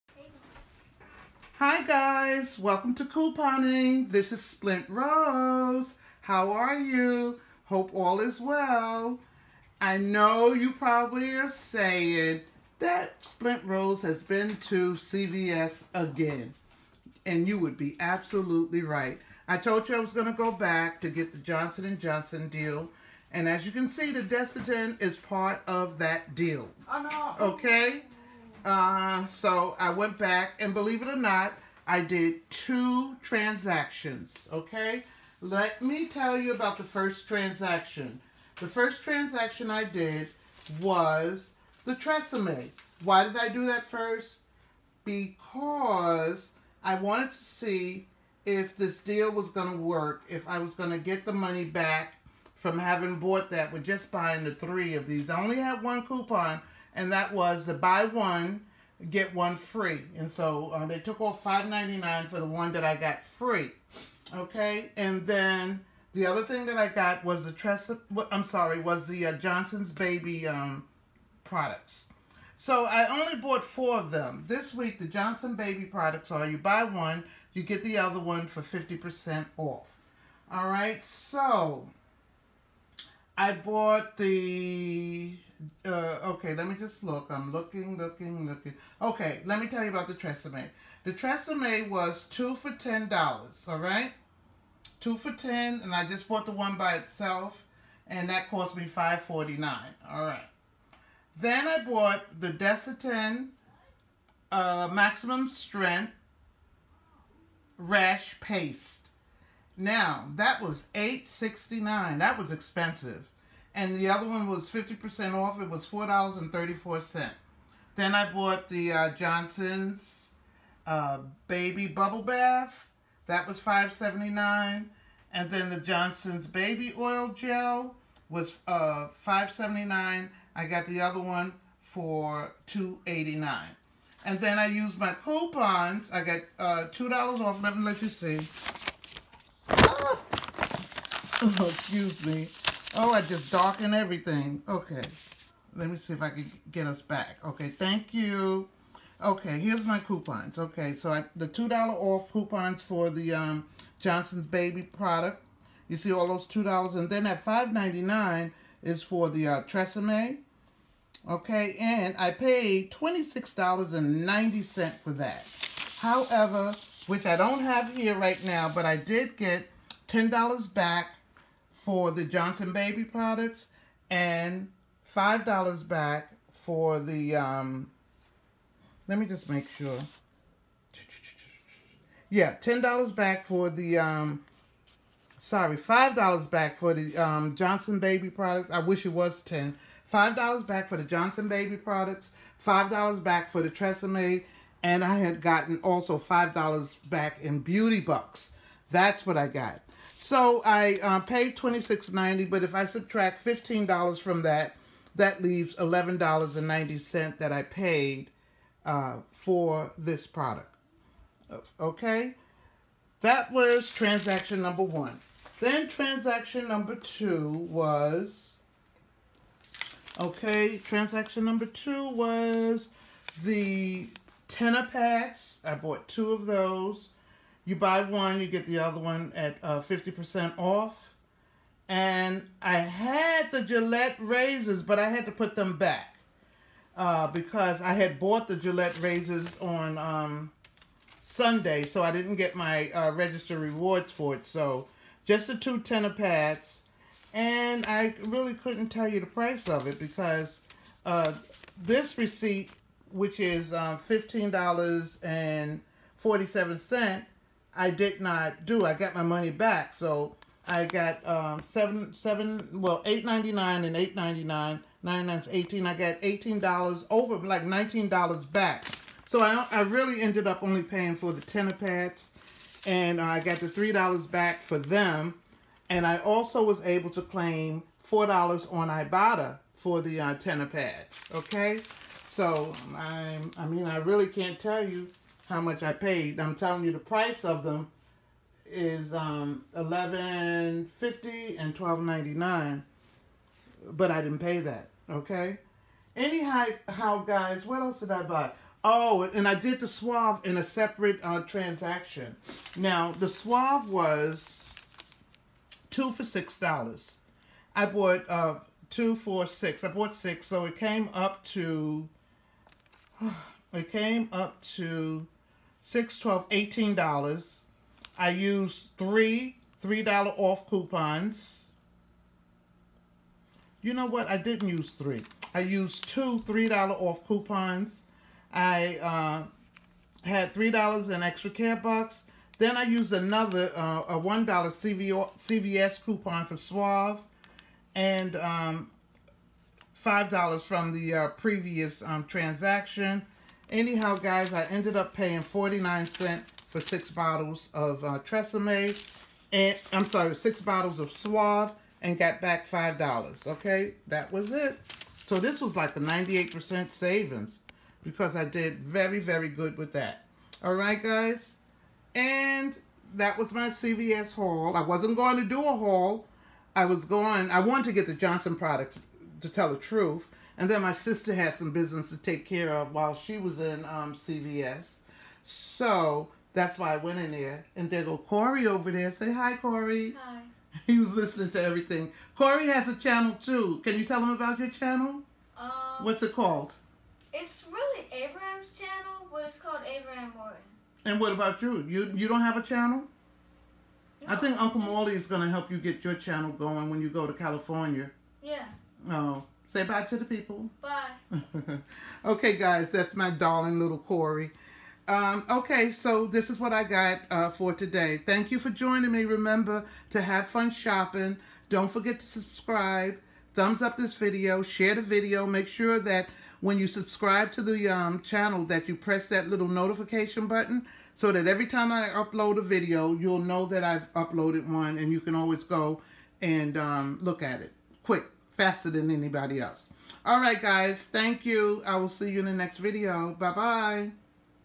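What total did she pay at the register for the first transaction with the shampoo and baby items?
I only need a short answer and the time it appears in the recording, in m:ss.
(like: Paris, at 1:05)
$26.90, at 2:42.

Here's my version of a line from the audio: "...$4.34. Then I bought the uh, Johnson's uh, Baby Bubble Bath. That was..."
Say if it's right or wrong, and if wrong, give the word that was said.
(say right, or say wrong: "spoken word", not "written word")
right.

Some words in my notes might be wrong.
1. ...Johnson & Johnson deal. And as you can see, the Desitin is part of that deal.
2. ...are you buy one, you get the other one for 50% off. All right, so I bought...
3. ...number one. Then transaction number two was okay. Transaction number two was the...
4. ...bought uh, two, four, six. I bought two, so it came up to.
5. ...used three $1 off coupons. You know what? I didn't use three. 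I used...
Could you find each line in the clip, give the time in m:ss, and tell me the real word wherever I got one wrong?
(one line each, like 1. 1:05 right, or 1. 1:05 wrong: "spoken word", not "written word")
1. 0:21 right
2. 1:16 right
3. 3:34 right
4. 5:07 wrong: "six", not "two"
5. 5:18 wrong: "3", not "1".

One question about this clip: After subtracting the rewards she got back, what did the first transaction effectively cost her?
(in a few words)
$11.90.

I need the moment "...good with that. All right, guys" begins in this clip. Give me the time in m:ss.
5:59.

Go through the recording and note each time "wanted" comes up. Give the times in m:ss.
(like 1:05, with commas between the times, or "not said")
0:46, 6:07.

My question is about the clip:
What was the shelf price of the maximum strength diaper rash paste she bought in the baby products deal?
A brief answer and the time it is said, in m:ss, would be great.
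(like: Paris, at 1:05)
$8.69, at 1:50.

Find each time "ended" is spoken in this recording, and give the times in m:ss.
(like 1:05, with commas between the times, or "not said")
4:30, 5:44.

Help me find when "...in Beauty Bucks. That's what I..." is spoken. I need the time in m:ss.
3:17.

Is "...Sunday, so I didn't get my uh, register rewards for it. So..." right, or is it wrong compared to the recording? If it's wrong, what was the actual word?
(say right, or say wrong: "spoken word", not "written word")
right.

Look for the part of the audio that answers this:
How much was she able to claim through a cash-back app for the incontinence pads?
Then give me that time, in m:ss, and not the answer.
4:37.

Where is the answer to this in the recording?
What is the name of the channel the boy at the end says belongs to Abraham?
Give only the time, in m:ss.
6:29.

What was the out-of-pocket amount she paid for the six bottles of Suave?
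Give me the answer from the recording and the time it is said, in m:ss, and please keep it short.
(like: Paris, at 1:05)
49 cents, at 5:45.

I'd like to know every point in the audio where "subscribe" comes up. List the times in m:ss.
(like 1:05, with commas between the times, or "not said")
6:52, 6:56.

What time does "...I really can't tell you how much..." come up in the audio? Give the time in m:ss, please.
4:43.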